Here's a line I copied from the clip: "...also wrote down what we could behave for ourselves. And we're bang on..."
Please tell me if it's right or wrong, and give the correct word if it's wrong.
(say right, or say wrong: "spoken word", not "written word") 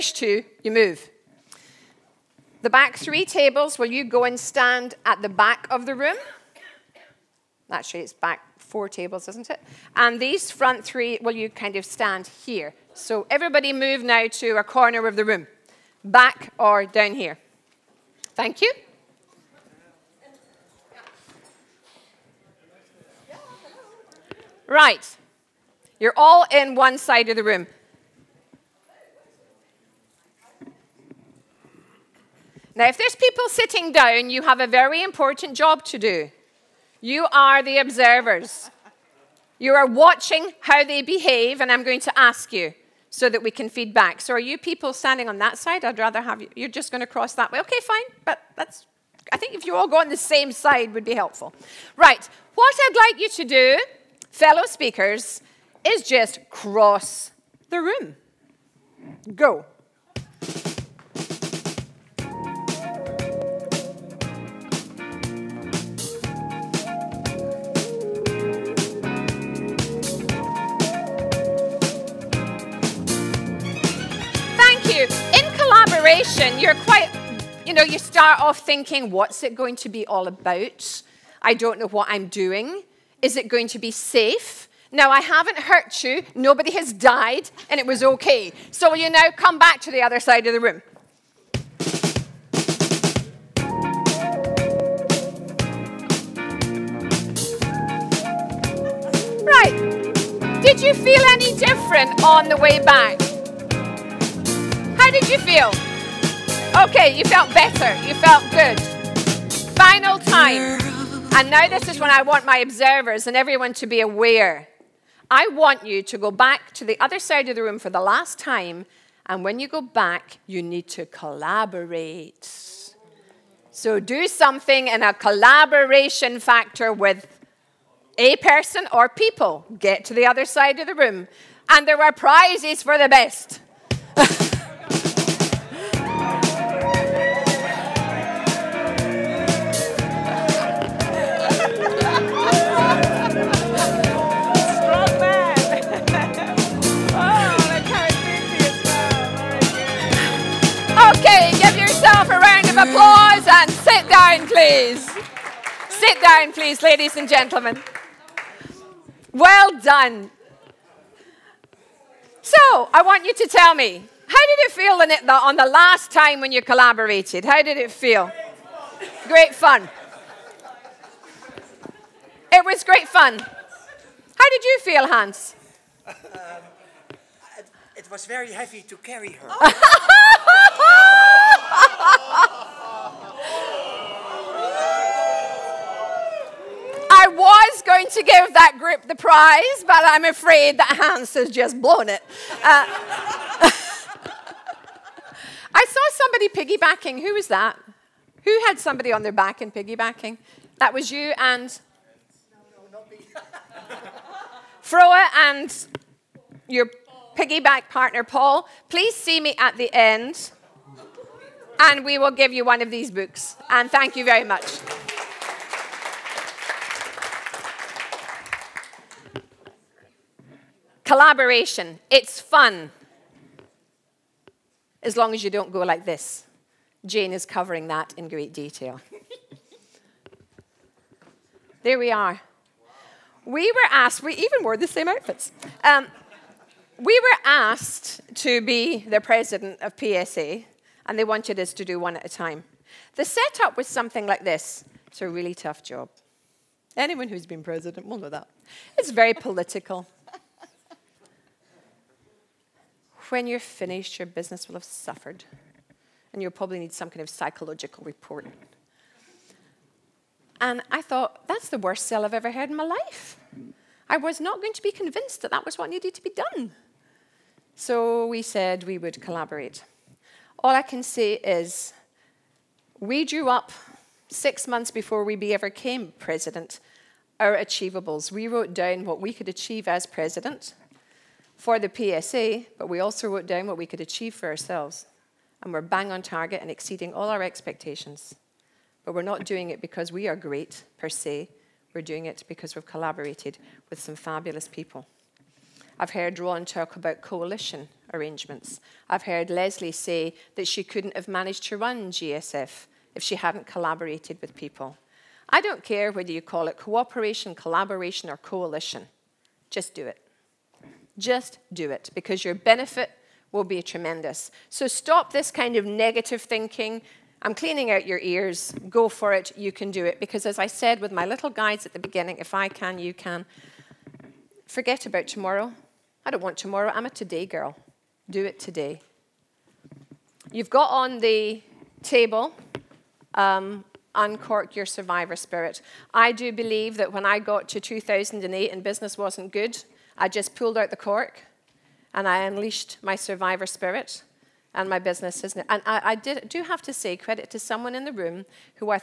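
wrong: "achieve", not "behave".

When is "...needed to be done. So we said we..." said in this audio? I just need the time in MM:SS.
04:25.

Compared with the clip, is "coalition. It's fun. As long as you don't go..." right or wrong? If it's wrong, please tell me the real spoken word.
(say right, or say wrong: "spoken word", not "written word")
wrong: "collaboration", not "coalition".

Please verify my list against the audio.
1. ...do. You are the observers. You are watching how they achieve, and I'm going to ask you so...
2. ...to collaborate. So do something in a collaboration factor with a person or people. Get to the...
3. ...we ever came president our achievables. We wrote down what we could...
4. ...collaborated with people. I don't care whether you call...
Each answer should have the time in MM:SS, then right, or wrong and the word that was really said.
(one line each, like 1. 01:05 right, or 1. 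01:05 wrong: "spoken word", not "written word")
1. 00:35 wrong: "behave", not "achieve"
2. 02:00 right
3. 04:35 right
4. 05:03 right.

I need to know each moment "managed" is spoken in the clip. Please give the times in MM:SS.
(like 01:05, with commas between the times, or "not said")
05:01.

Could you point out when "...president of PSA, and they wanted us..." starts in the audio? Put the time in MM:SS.
03:59.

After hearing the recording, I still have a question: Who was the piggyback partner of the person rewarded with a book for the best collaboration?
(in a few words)
Paul.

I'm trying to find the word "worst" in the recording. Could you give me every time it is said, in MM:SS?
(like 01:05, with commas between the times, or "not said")
04:21.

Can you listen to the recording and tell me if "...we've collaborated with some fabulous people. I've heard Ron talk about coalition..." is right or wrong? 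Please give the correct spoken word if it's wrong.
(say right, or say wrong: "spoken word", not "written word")
right.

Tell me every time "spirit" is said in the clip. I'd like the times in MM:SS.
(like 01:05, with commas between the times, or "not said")
05:35, 05:43.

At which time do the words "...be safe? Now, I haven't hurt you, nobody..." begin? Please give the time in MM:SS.
01:23.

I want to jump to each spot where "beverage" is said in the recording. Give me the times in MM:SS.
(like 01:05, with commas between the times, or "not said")
not said.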